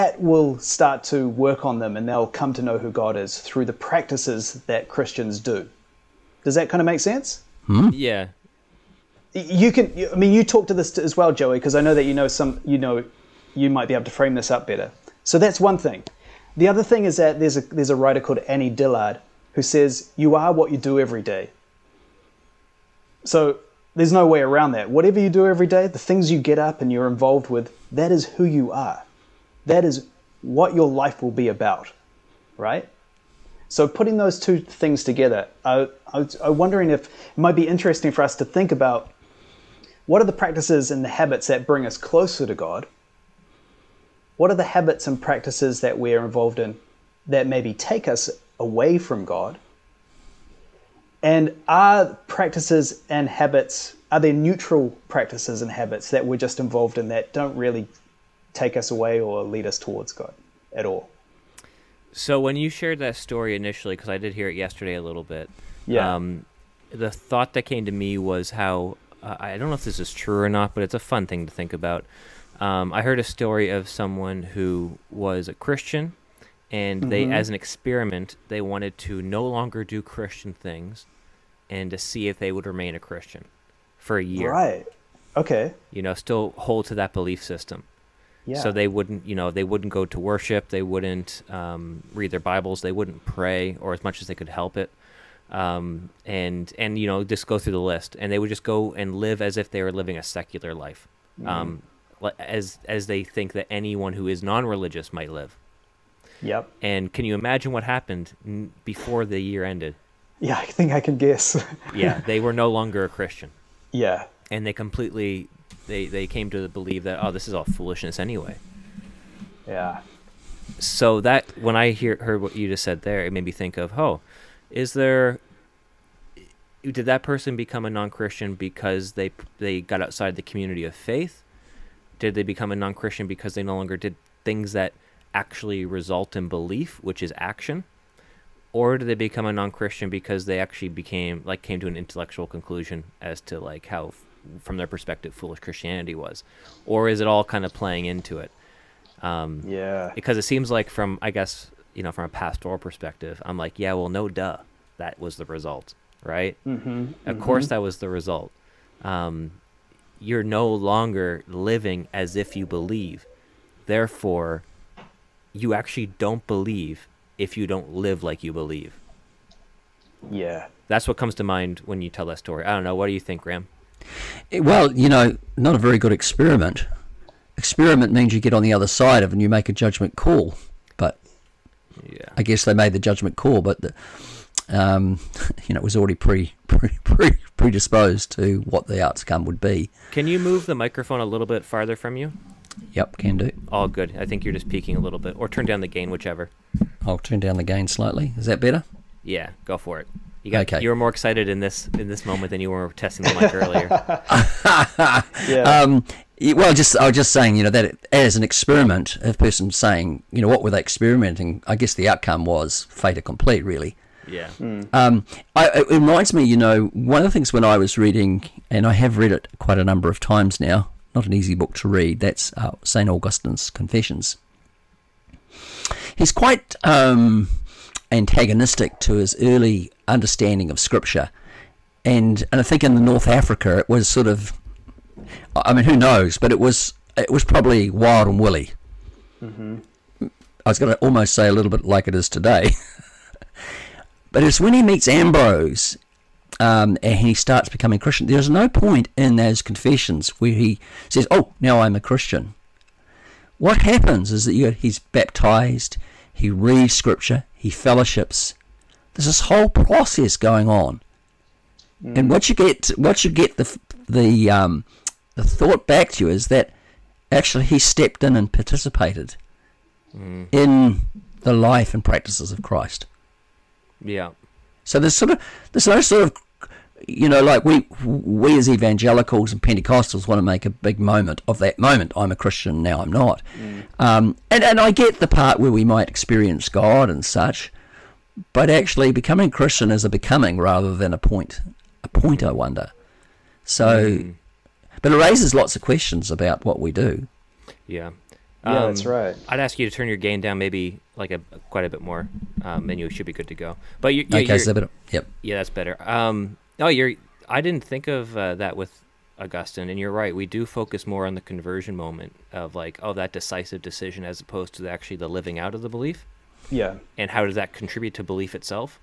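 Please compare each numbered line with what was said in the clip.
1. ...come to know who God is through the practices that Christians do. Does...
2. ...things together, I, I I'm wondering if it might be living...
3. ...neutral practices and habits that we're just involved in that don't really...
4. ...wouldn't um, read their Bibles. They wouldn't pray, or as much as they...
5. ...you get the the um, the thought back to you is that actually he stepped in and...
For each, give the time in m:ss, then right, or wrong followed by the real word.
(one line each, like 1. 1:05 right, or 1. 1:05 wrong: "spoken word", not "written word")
1. 0:02 right
2. 0:34 wrong: "interesting", not "living"
3. 0:54 right
4. 1:30 right
5. 4:23 right.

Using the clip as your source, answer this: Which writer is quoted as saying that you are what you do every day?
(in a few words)
Annie Dillard.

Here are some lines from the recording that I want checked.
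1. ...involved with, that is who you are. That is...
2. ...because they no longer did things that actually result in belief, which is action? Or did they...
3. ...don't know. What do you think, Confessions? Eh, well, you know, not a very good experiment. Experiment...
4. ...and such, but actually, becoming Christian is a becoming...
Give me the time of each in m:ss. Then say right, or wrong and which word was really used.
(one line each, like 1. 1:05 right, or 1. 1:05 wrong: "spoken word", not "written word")
1. 0:27 right
2. 2:13 right
3. 2:52 wrong: "Graham", not "Confessions"
4. 4:47 right.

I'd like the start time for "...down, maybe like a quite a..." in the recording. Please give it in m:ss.
5:00.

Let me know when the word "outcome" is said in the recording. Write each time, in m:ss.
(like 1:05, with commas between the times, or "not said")
3:09, 3:32.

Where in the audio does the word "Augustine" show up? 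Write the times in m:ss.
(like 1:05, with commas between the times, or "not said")
3:43, 5:09.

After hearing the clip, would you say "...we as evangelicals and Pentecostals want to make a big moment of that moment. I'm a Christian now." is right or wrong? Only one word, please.
right.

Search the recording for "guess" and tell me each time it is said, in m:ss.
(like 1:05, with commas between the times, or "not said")
1:51, 2:31, 3:02, 3:31.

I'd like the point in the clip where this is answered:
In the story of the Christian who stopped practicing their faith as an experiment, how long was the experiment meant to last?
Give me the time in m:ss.
1:24.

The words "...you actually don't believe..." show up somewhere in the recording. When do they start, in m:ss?
2:45.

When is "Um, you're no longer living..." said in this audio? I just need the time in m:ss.
2:39.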